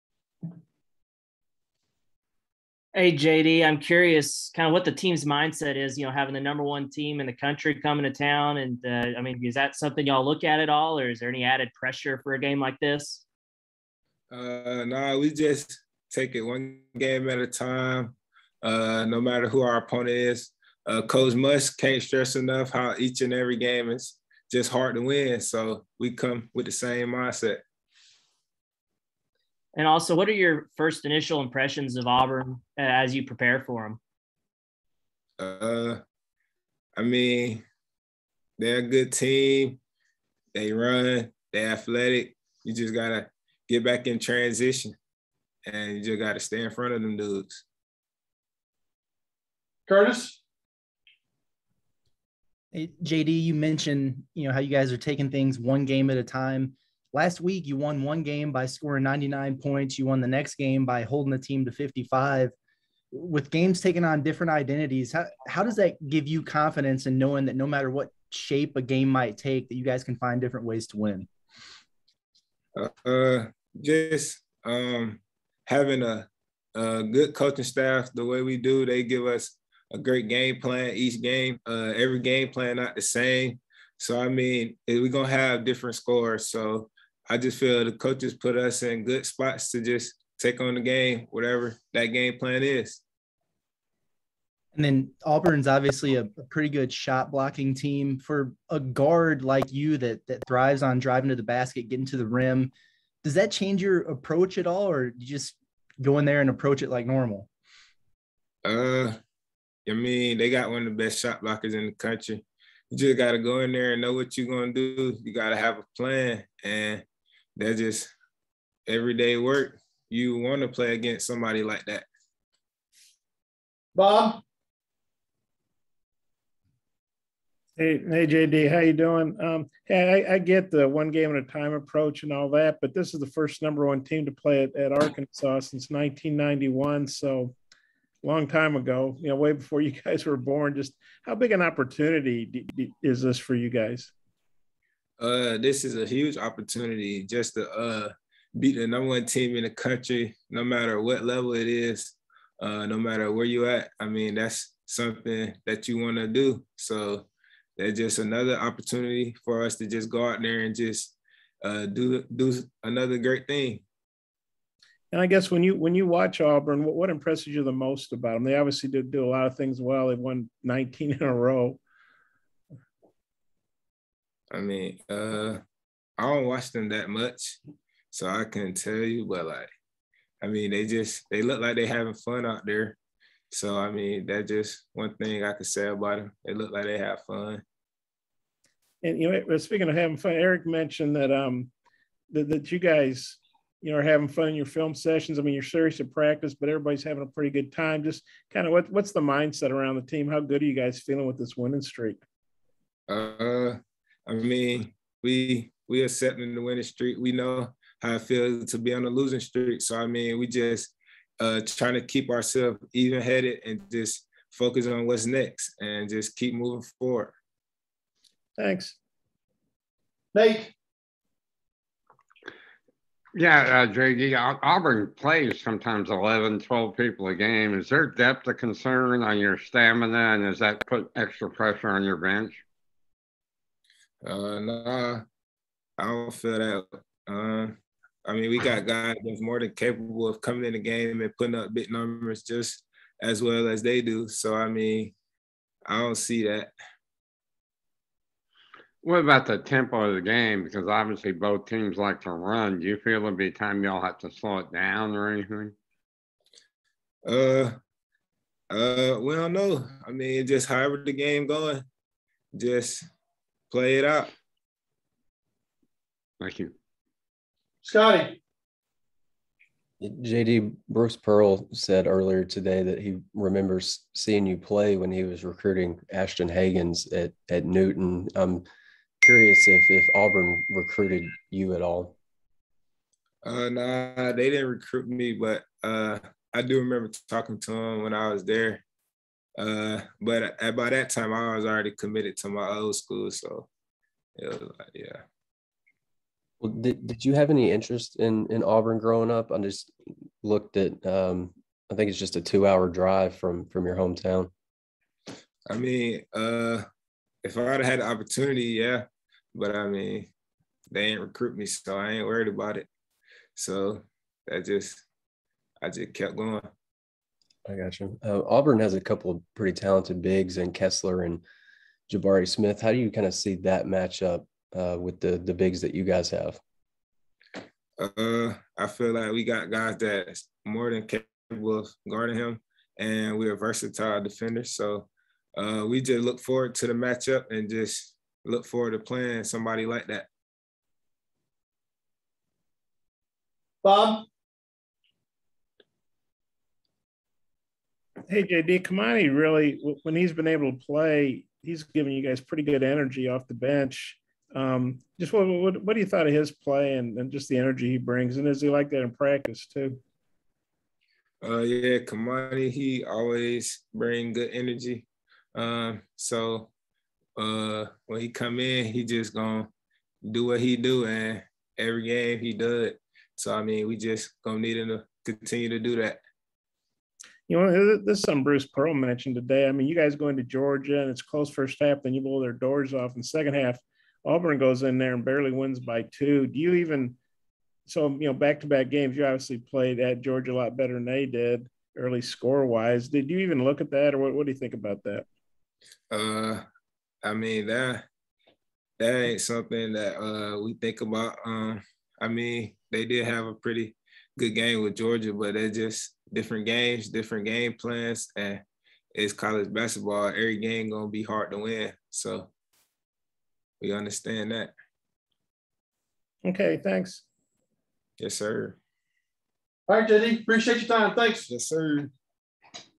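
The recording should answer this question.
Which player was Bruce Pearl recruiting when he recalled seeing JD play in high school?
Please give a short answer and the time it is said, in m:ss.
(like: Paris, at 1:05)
Ashton Hagans, at 4:36.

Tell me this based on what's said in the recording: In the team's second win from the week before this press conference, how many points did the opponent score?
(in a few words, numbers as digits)
55.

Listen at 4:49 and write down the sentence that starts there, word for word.
Uh, but at, by that time, I was already committed to my old school, so it was like, yeah.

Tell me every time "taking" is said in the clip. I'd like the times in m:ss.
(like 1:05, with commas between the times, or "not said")
0:54, 1:03.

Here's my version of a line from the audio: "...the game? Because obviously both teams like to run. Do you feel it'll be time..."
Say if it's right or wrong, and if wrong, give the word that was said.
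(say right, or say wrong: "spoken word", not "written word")
right.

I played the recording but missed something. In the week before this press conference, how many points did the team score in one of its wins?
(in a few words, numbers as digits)
99.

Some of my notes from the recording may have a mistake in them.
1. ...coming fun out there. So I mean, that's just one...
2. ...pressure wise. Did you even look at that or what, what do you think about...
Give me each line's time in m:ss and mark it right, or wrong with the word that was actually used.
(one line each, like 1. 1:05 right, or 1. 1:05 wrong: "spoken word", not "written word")
1. 3:01 wrong: "having", not "coming"
2. 6:32 wrong: "score", not "pressure".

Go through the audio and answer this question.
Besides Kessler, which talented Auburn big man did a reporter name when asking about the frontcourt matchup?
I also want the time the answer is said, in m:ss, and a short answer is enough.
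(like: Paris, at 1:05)
Jabari Smith, at 5:22.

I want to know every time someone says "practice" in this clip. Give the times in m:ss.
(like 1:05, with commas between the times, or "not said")
3:16, 5:59.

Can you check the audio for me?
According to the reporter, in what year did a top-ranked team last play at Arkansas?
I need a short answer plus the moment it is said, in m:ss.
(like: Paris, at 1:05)
1991, at 2:15.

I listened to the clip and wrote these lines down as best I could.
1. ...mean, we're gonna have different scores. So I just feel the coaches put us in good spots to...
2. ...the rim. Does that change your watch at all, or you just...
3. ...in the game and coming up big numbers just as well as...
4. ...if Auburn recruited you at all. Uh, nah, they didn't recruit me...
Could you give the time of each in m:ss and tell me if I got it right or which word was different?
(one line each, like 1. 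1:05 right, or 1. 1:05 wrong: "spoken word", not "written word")
1. 1:24 right
2. 1:42 wrong: "approach", not "watch"
3. 4:00 wrong: "putting", not "coming"
4. 4:39 right.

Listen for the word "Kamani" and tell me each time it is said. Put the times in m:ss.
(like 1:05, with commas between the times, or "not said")
5:48, 6:01.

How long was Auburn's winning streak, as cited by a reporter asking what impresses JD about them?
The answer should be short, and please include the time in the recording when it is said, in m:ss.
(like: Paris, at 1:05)
19, at 2:50.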